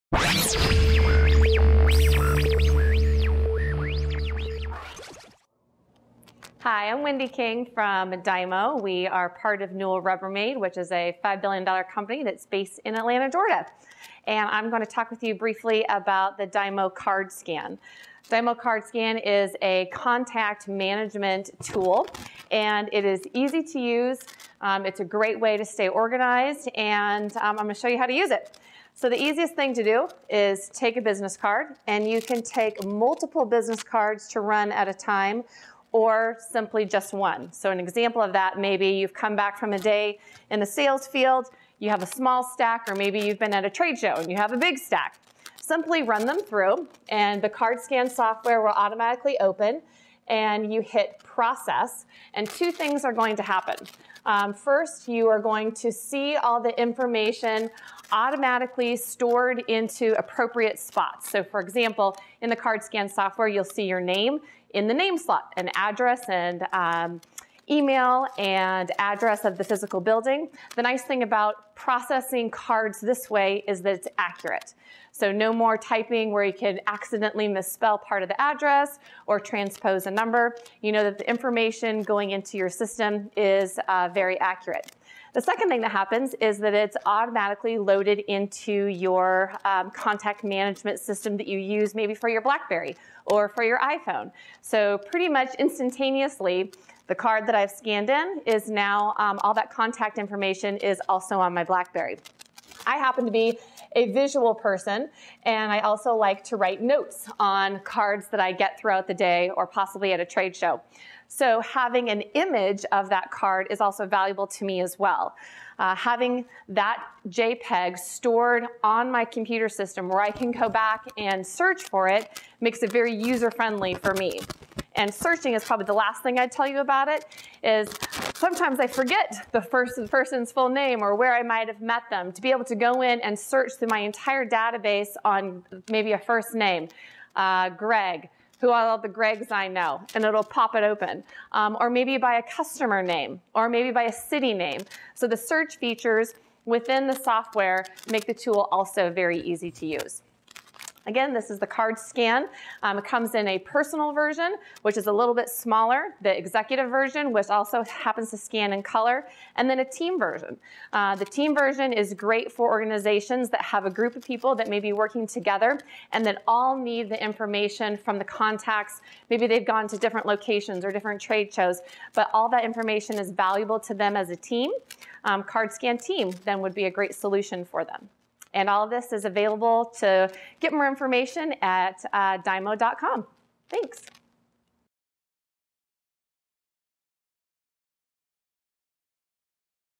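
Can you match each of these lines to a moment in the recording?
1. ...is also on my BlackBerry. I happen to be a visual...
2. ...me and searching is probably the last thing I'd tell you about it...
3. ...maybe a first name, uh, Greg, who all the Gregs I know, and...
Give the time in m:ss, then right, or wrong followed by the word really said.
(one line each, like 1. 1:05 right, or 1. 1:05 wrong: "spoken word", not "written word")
1. 1:40 right
2. 2:04 right
3. 2:15 right.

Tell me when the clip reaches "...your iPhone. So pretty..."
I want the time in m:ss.
1:33.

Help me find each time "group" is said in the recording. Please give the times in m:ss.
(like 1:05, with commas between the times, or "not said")
2:43.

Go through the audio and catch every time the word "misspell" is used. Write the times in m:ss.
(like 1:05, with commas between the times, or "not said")
1:17.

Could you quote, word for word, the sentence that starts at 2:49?
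Maybe they've gone to different locations or different trade shows, but all that information is valuable to them as a team.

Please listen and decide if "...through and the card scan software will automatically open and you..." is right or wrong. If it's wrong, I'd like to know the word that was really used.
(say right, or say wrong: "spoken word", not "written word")
right.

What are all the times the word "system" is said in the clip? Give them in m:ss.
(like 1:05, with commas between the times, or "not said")
1:22, 1:30, 1:59.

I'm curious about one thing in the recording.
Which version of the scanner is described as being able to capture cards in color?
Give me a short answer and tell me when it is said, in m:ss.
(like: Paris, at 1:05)
executive version, at 2:36.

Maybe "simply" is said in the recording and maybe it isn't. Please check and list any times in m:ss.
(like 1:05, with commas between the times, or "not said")
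0:36, 0:45.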